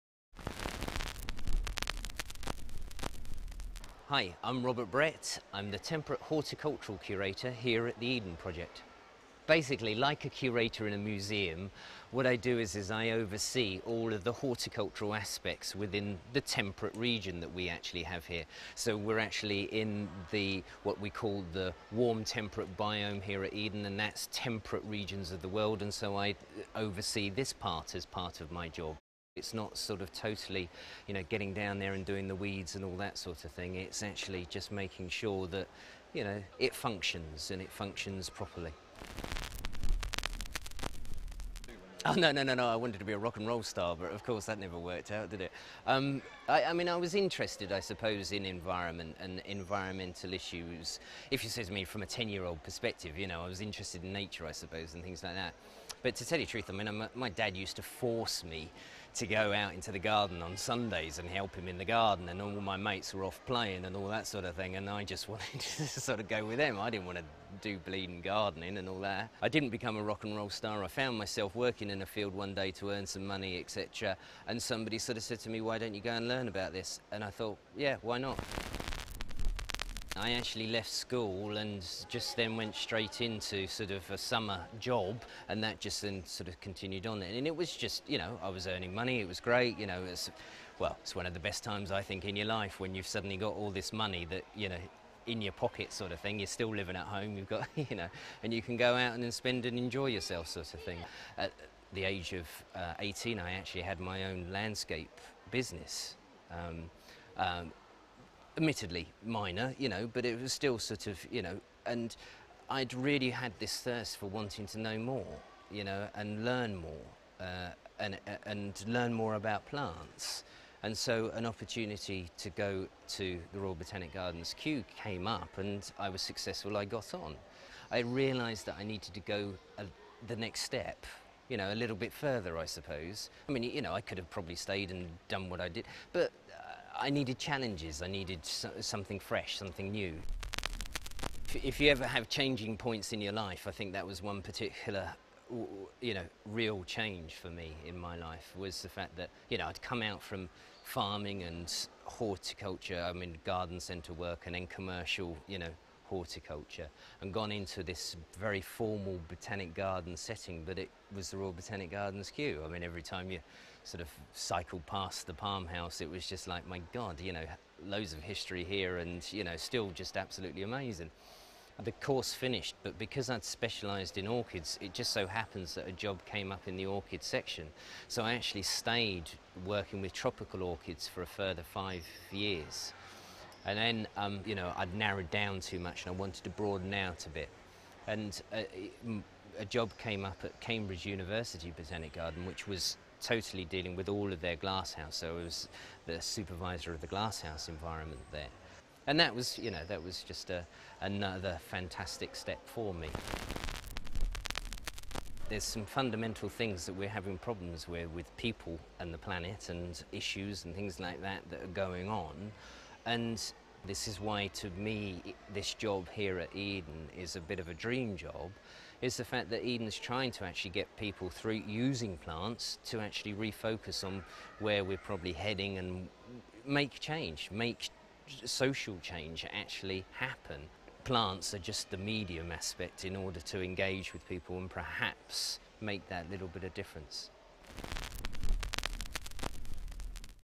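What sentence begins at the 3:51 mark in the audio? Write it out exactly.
Plants are just the medium aspect in order to engage with people and perhaps make that little bit of difference.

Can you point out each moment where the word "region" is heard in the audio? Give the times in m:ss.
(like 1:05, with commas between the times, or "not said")
0:16, 0:24.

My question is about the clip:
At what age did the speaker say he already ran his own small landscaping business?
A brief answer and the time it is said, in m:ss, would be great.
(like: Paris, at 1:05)
18, at 1:42.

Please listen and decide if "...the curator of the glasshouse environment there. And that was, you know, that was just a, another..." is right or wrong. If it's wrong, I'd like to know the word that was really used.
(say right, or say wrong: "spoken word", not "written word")
wrong: "supervisor", not "curator".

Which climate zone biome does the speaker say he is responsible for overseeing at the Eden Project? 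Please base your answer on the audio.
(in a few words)
Warm temperate biome.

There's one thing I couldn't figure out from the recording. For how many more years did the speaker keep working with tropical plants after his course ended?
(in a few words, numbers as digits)
5.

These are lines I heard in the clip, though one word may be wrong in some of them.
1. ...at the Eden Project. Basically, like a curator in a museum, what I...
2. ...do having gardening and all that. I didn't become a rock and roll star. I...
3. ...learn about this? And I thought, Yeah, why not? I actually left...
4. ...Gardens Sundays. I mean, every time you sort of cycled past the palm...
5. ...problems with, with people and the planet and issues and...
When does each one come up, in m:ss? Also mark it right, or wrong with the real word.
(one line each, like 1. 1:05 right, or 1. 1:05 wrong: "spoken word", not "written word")
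1. 0:07 right
2. 1:07 wrong: "bleeding", not "having"
3. 1:16 right
4. 2:41 wrong: "Kew", not "Sundays"
5. 3:27 right.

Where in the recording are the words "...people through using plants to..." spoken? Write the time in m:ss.
3:40.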